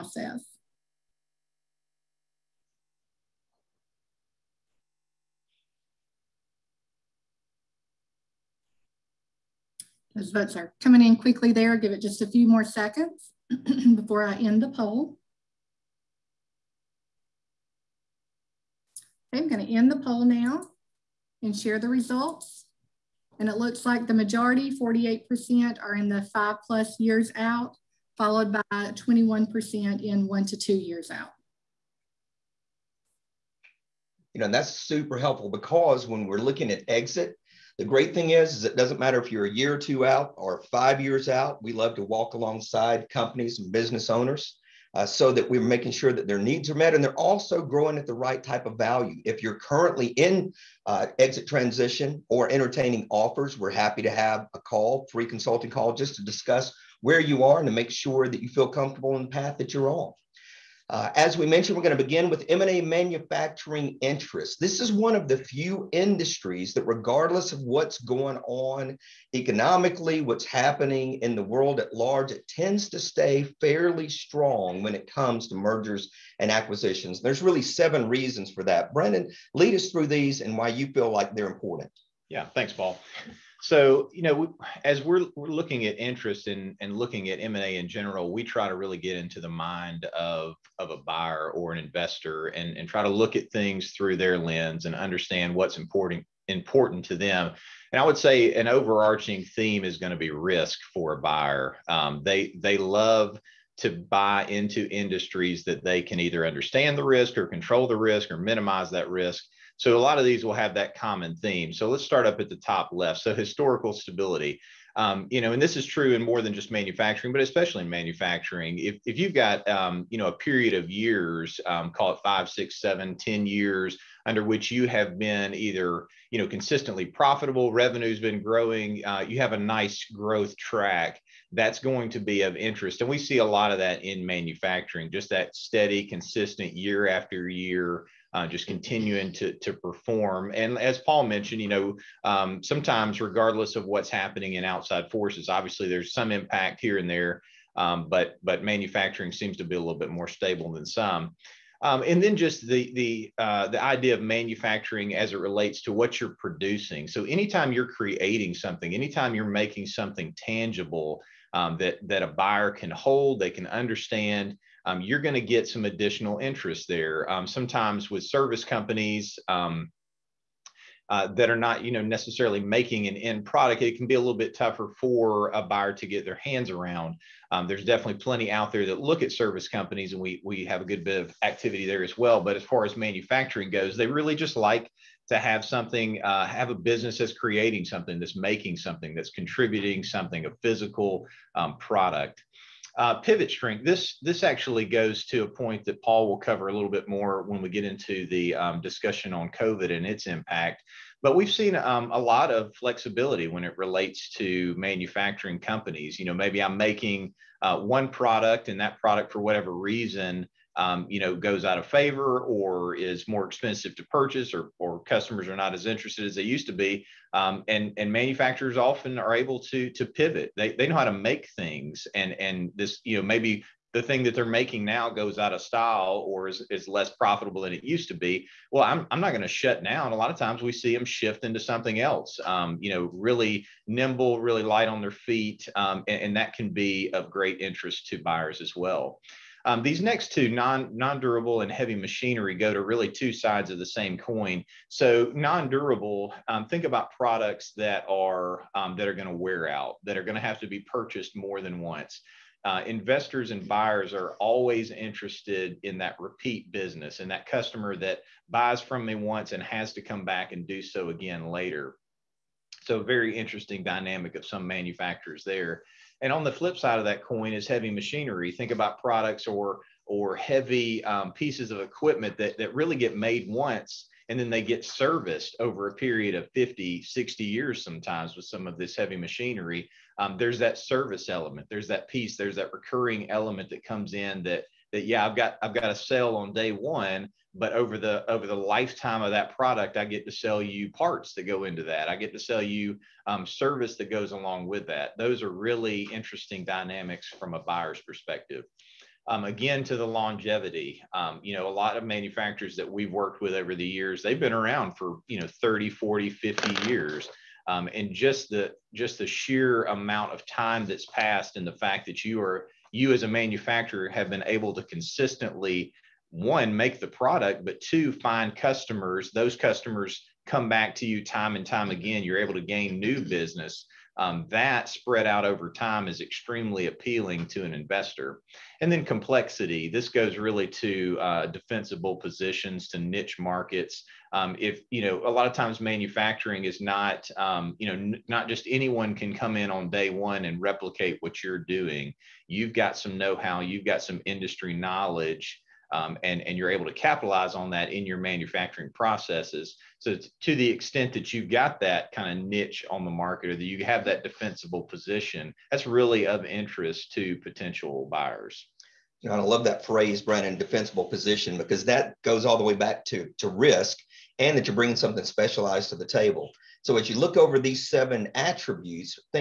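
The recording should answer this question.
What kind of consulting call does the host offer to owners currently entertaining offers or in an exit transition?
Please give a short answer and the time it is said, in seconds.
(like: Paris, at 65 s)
free consulting call, at 55 s.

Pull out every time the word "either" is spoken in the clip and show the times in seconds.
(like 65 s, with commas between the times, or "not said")
106 s, 125 s.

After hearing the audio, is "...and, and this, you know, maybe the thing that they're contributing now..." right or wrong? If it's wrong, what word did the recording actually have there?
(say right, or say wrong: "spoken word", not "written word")
wrong: "making", not "contributing".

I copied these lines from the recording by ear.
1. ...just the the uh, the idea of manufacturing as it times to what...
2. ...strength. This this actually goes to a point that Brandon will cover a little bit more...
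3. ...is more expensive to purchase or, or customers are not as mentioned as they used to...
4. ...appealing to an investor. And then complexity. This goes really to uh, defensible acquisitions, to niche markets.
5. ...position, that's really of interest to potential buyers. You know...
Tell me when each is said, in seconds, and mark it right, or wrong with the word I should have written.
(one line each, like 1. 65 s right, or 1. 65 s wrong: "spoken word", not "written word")
1. 152 s wrong: "relates", not "times"
2. 193 s wrong: "Paul", not "Brandon"
3. 212 s wrong: "interested", not "mentioned"
4. 326 s wrong: "positions", not "acquisitions"
5. 354 s right.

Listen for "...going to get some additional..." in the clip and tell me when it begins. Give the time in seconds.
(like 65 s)
165 s.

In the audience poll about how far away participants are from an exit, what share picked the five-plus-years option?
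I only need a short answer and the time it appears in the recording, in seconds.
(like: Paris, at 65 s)
48%, at 24 s.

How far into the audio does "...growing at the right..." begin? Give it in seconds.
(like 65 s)
47 s.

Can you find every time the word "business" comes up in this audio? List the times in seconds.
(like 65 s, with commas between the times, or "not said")
43 s, 186 s, 256 s, 323 s.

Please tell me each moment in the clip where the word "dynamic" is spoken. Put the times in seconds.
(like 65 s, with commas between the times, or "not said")
263 s, 296 s.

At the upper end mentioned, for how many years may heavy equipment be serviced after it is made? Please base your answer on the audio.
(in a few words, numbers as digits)
60.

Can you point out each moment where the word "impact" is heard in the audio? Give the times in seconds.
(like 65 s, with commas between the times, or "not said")
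146 s, 200 s.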